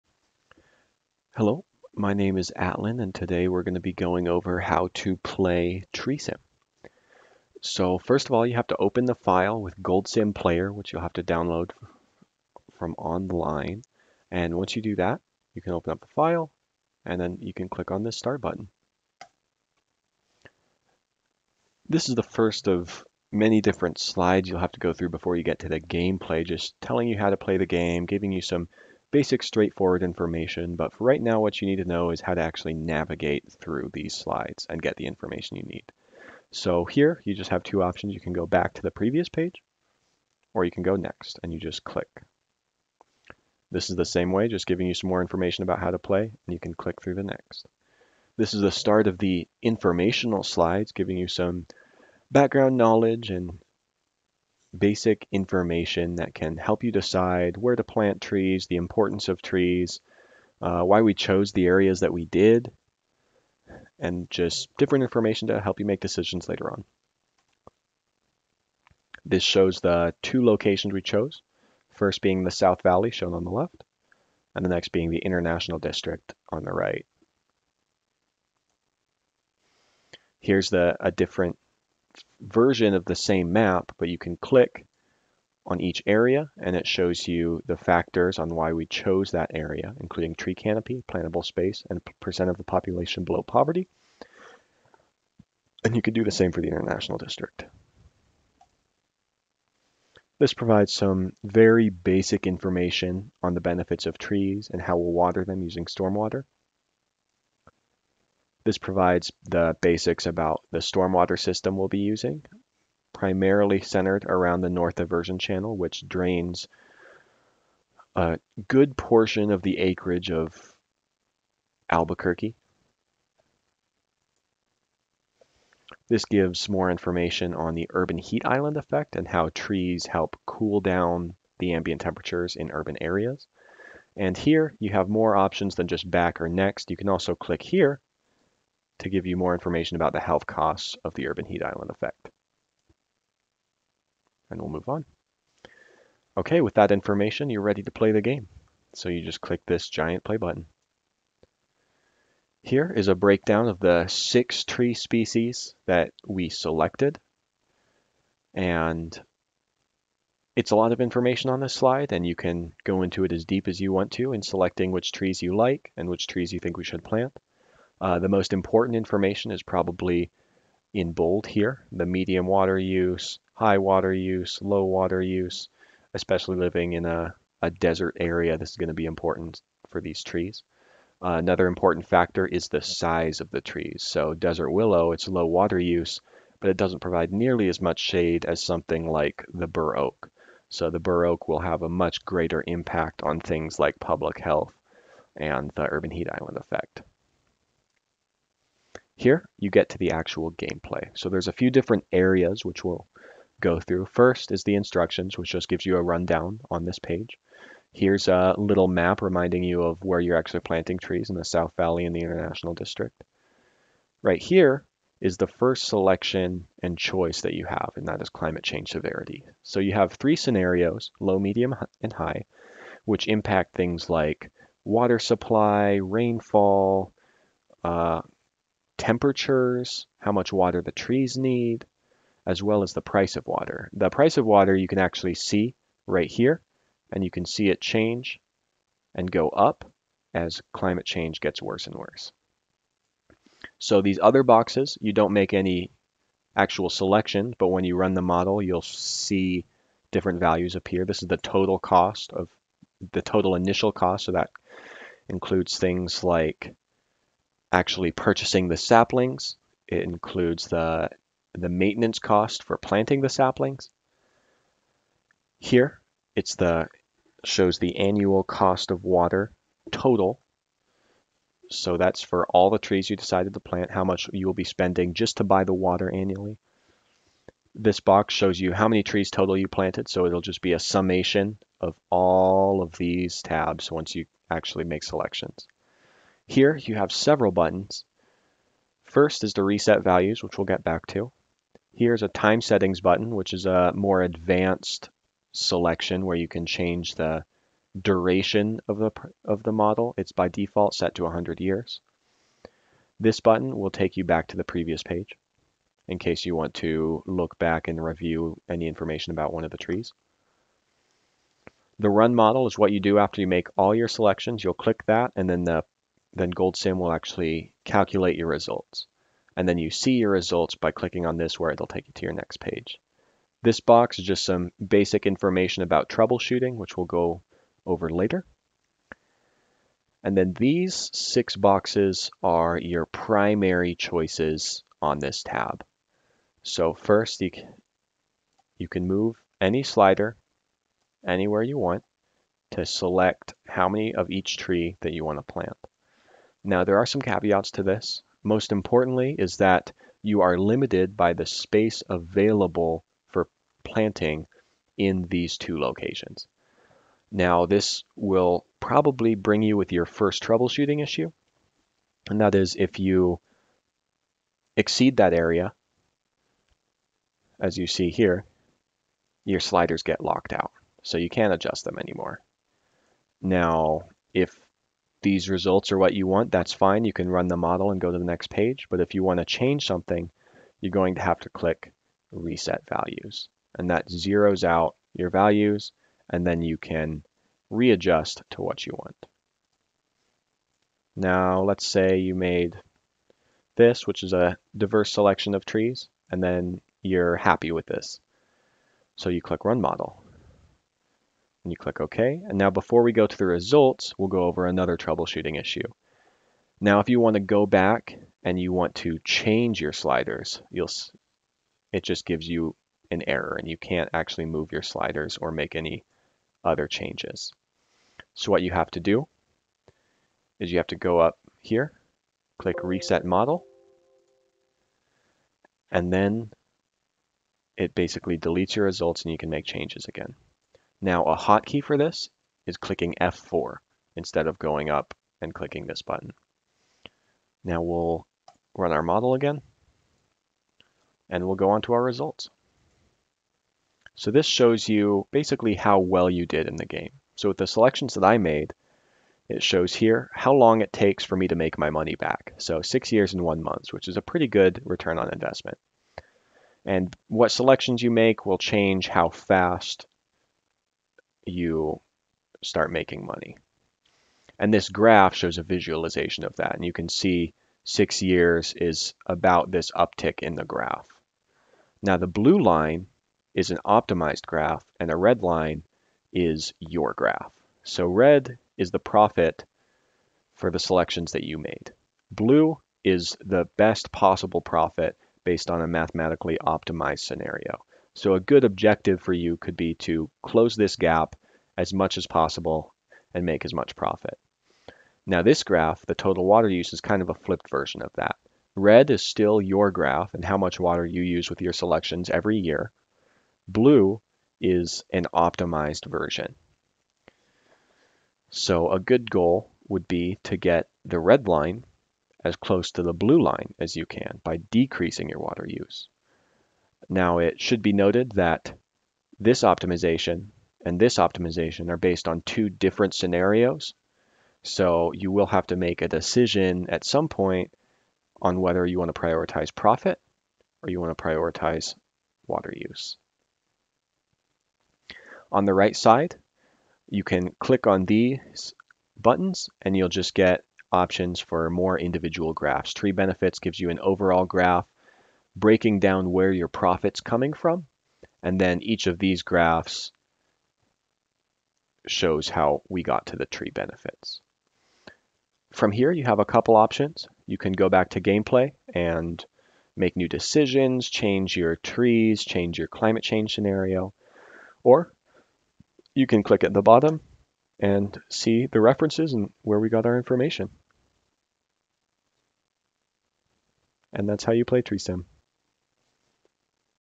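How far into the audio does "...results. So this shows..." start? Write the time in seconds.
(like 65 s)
442 s.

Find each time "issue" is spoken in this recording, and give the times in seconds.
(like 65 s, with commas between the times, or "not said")
361 s, 405 s.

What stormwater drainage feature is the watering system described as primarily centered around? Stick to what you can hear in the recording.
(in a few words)
North Diversion Channel.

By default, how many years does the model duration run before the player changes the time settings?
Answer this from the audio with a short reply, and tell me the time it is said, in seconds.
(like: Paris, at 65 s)
100 years, at 301 s.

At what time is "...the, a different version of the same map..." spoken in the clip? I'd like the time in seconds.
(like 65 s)
80 s.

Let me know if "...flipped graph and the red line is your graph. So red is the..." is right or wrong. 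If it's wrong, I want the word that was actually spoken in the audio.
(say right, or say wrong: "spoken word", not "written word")
wrong: "optimized", not "flipped".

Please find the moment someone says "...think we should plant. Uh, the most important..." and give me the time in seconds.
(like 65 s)
166 s.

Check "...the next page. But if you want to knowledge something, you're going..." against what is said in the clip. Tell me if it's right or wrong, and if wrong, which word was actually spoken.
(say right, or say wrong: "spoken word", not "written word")
wrong: "change", not "knowledge".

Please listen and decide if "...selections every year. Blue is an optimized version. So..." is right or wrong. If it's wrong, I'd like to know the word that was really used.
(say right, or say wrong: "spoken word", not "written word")
right.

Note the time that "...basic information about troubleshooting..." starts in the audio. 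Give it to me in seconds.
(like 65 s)
324 s.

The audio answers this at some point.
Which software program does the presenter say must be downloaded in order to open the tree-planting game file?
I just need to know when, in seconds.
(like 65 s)
9 s.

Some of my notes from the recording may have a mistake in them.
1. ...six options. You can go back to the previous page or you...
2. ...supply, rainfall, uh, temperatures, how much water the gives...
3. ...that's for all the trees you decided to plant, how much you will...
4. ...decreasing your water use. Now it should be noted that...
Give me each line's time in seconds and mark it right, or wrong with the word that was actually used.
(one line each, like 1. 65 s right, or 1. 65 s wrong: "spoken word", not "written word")
1. 37 s wrong: "two", not "six"
2. 225 s wrong: "trees", not "gives"
3. 271 s right
4. 514 s right.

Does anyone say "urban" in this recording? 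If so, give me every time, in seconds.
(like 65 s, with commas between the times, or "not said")
127 s, 132 s, 141 s, 195 s.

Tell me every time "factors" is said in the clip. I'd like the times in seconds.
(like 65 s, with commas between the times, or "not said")
87 s, 182 s.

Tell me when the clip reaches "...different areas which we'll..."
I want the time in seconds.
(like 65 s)
201 s.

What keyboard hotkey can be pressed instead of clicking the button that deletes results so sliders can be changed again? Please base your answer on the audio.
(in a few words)
F4.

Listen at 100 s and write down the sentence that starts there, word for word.
This provides some very basic information on the benefits of trees and how we'll water them using stormwater.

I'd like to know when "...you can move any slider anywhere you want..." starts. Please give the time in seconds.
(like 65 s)
338 s.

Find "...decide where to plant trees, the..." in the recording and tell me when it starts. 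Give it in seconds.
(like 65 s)
56 s.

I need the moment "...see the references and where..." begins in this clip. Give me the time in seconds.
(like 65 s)
568 s.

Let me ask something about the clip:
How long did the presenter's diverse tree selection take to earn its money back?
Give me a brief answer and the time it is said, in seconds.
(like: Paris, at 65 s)
6 years and 1 month, at 452 s.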